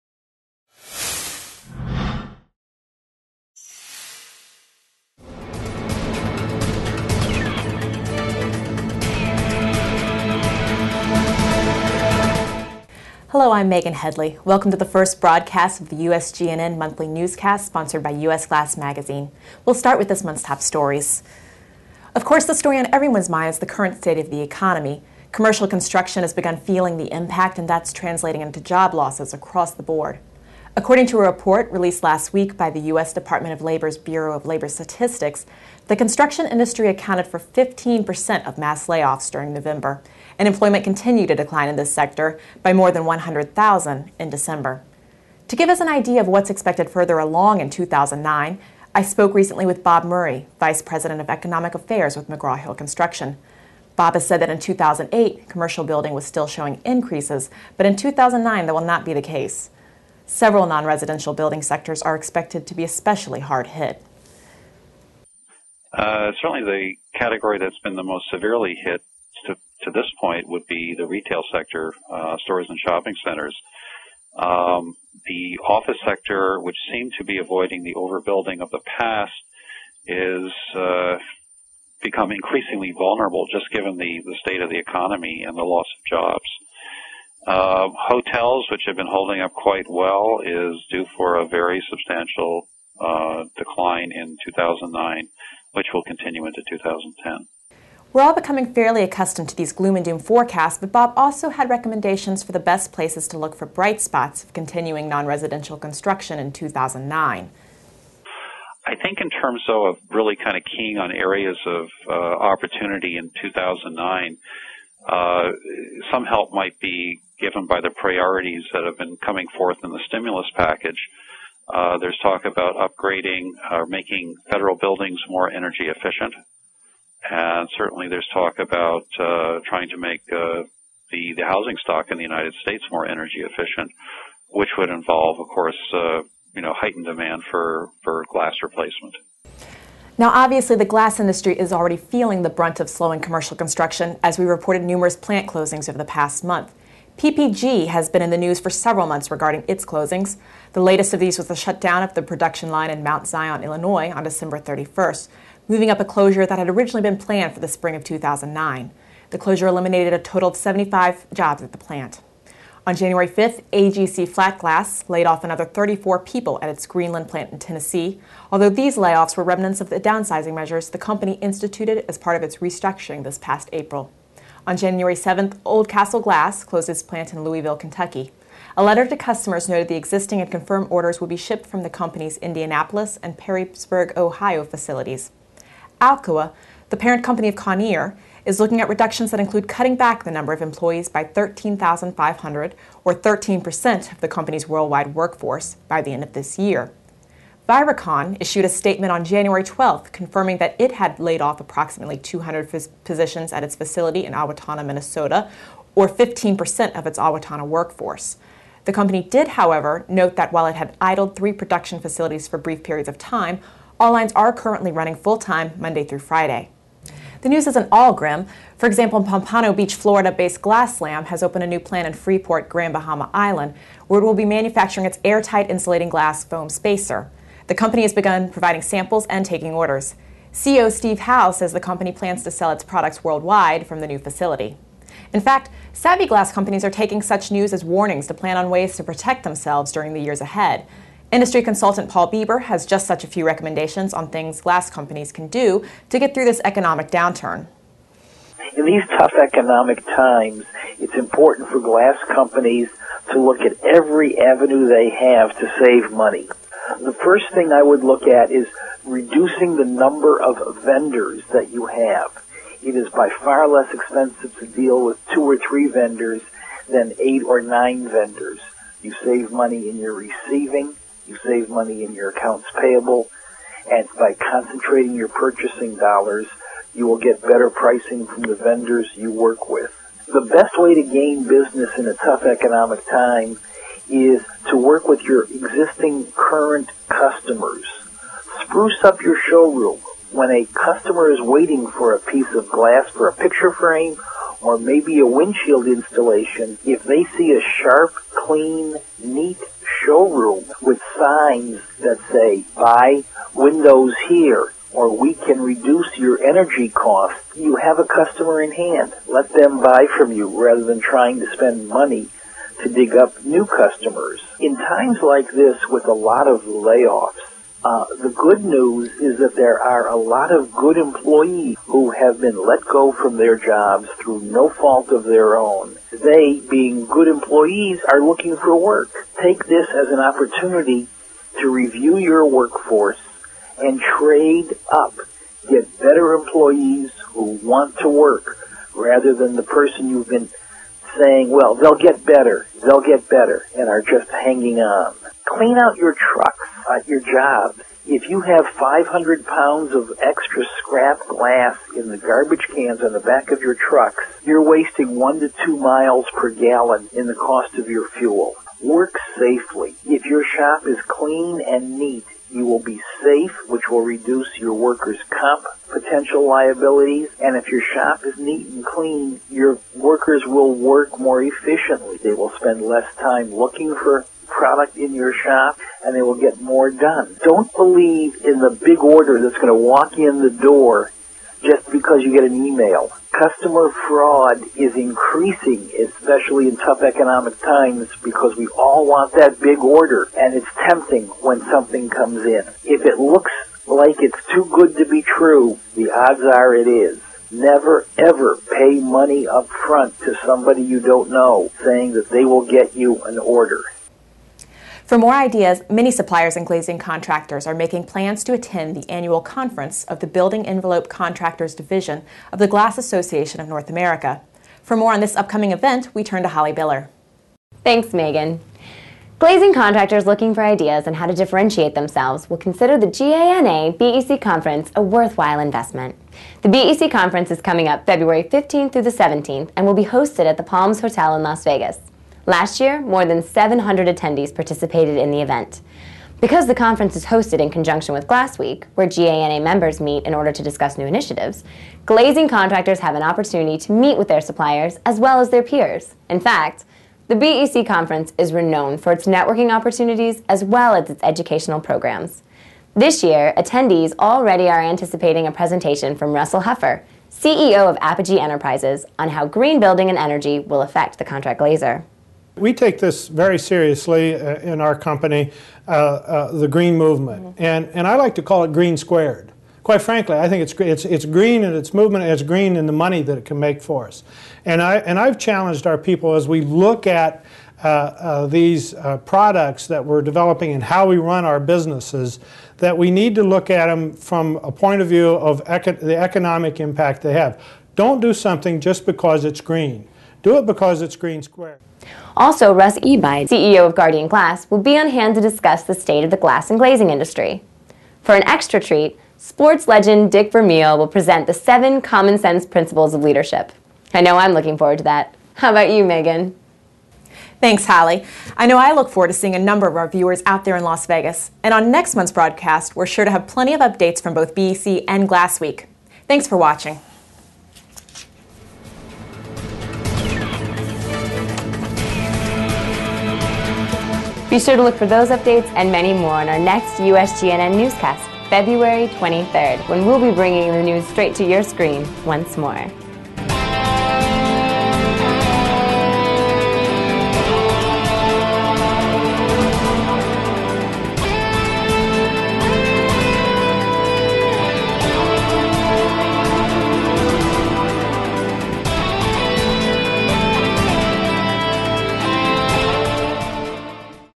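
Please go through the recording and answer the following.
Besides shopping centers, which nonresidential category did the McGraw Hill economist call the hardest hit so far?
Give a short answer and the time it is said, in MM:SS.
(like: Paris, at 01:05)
retail sector, at 01:11.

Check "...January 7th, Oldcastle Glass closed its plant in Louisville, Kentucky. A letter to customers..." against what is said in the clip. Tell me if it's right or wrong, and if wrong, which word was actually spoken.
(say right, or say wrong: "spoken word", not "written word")
right.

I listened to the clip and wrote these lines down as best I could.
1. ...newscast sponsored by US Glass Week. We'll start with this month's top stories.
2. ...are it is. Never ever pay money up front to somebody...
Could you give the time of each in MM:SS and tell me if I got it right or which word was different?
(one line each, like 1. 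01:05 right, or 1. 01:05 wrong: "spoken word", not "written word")
1. 00:17 wrong: "Magazine", not "Week"
2. 06:36 right.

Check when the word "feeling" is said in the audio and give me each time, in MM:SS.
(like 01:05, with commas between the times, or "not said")
00:26, 02:21.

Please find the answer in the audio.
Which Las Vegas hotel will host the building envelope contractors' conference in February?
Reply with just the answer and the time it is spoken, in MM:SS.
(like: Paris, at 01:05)
Palms Hotel, at 07:10.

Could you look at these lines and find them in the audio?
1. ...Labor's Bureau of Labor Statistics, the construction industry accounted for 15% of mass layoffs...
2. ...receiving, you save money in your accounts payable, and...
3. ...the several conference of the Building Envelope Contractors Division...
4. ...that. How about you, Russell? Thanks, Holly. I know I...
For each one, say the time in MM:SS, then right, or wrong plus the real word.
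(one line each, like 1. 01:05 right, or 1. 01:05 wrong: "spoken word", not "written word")
1. 00:33 right
2. 04:30 right
3. 06:48 wrong: "annual", not "several"
4. 08:25 wrong: "Megan", not "Russell".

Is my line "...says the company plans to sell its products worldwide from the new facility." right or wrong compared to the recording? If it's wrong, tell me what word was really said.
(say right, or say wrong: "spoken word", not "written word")
right.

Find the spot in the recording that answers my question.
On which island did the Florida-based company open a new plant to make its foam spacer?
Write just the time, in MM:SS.
03:42.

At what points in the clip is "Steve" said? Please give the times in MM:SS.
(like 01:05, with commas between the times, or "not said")
03:50.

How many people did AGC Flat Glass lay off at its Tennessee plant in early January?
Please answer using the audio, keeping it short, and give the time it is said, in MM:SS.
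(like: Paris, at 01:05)
34, at 02:45.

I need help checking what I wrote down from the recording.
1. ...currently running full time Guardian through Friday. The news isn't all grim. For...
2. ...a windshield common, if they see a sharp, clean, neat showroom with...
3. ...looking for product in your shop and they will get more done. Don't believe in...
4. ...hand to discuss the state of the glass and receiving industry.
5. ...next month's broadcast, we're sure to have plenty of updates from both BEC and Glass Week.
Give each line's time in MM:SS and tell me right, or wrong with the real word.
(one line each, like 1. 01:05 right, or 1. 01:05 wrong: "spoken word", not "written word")
1. 03:34 wrong: "Monday", not "Guardian"
2. 04:55 wrong: "installation", not "common"
3. 06:13 right
4. 08:15 wrong: "glazing", not "receiving"
5. 08:31 right.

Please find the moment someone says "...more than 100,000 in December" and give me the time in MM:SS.
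00:42.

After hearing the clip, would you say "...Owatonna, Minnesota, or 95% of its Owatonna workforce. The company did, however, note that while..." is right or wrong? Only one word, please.
wrong.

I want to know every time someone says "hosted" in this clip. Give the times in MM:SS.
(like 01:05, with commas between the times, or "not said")
07:10, 07:17.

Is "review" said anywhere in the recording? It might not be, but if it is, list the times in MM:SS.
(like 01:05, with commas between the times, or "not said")
05:31.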